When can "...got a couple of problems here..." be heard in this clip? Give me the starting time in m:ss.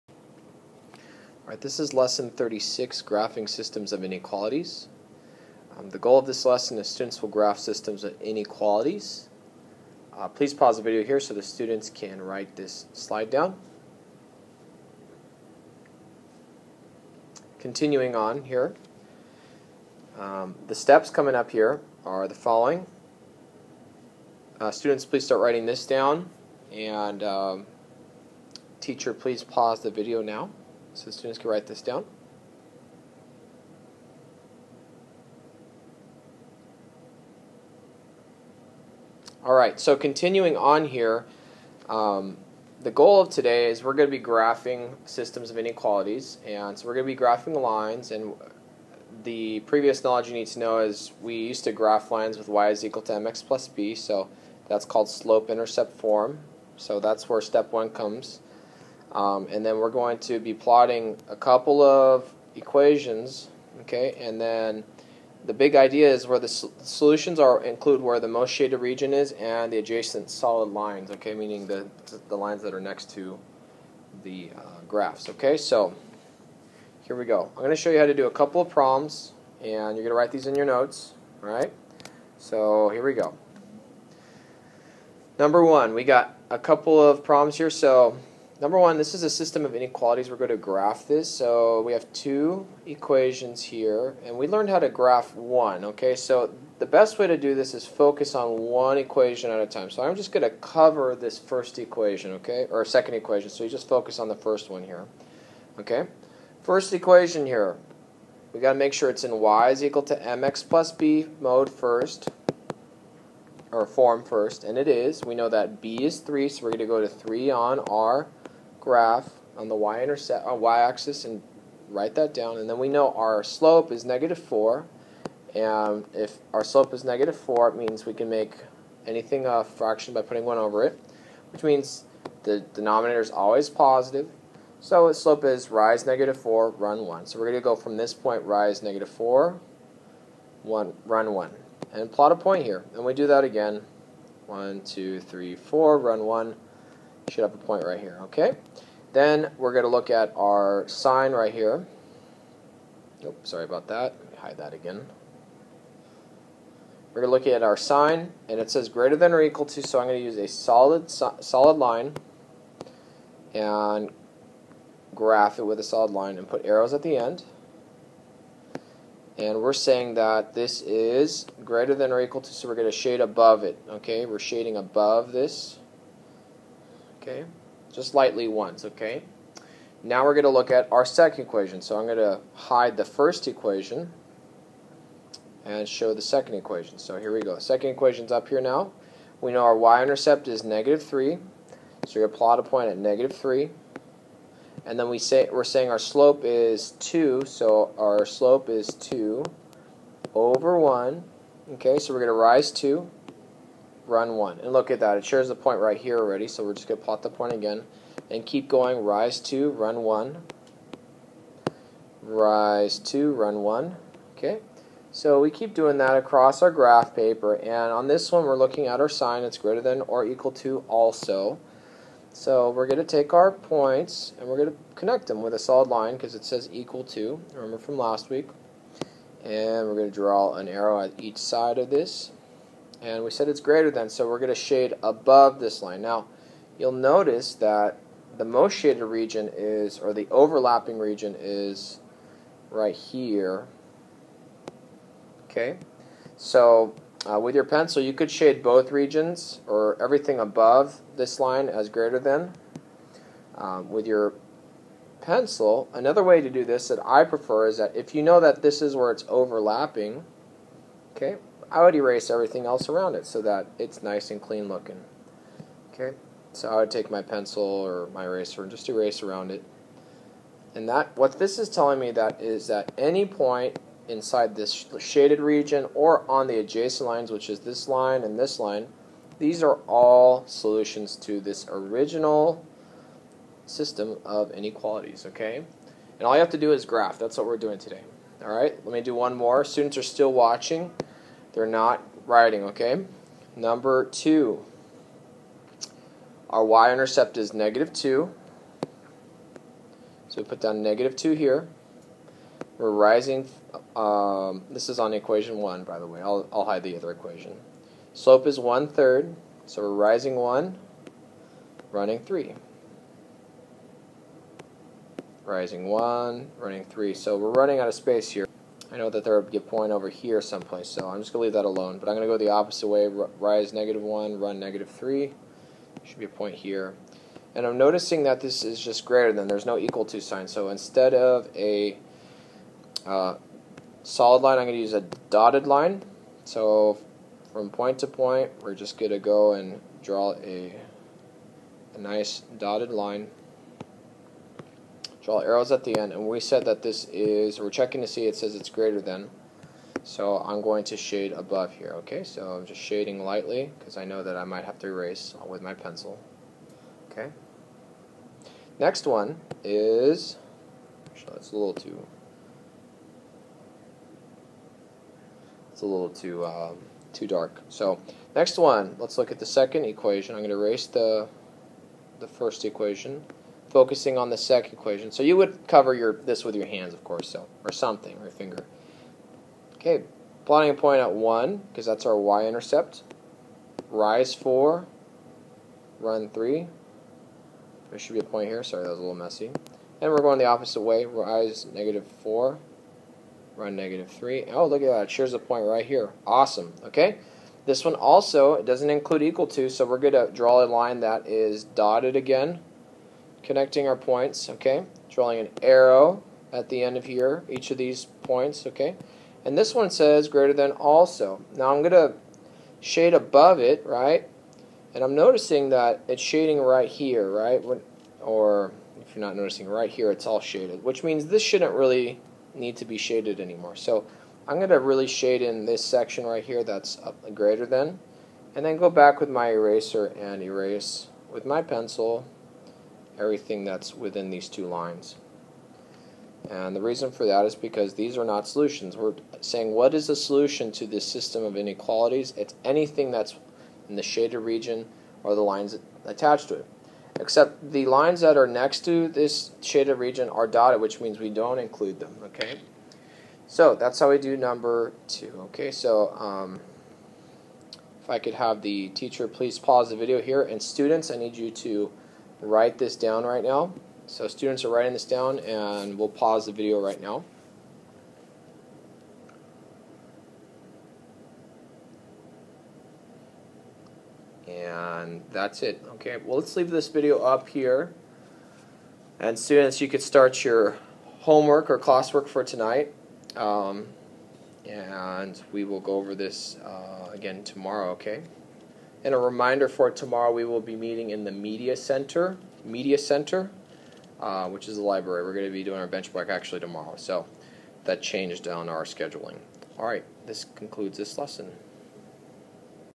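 1:26.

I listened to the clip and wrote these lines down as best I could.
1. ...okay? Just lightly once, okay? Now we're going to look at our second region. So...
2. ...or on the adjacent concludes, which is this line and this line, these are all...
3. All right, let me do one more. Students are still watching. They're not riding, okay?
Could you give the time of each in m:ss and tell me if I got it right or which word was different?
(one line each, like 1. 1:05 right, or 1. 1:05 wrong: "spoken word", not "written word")
1. 2:57 wrong: "equation", not "region"
2. 4:35 wrong: "lines", not "concludes"
3. 4:48 right.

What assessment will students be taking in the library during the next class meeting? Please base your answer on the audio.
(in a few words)
benchmark.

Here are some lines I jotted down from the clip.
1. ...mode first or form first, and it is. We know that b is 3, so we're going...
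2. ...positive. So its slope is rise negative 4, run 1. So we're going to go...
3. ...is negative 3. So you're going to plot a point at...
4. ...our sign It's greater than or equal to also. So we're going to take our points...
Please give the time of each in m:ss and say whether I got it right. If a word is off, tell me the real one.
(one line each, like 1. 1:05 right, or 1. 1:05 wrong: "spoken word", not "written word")
1. 1:51 right
2. 2:13 right
3. 3:10 right
4. 3:38 right.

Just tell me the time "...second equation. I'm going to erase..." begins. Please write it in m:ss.
6:09.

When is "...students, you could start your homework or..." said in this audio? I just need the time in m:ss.
7:59.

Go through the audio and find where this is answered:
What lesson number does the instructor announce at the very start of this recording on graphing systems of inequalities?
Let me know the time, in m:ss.
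0:01.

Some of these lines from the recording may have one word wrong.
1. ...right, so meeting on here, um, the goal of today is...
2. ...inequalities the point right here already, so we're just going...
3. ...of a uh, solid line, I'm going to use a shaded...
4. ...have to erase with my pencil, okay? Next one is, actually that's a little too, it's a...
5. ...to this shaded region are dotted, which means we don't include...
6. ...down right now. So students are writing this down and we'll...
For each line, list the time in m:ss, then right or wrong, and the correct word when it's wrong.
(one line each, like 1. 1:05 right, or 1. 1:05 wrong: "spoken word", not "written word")
1. 0:39 wrong: "continuing", not "meeting"
2. 3:25 wrong: "shares", not "inequalities"
3. 5:31 wrong: "dotted", not "shaded"
4. 5:54 right
5. 7:28 right
6. 7:42 right.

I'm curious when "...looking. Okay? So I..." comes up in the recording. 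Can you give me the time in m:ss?
4:24.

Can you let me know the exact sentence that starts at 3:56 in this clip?
Now, you'll notice that the most shaded region is, or the overlapping region is right here.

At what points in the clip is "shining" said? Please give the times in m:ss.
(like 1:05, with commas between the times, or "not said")
not said.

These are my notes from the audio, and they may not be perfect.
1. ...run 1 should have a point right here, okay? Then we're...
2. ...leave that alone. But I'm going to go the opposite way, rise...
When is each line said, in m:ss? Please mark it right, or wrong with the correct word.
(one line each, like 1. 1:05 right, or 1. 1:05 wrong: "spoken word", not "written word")
1. 2:25 right
2. 5:21 right.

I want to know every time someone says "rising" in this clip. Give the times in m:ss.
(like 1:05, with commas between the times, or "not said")
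5:02, 5:09, 5:15.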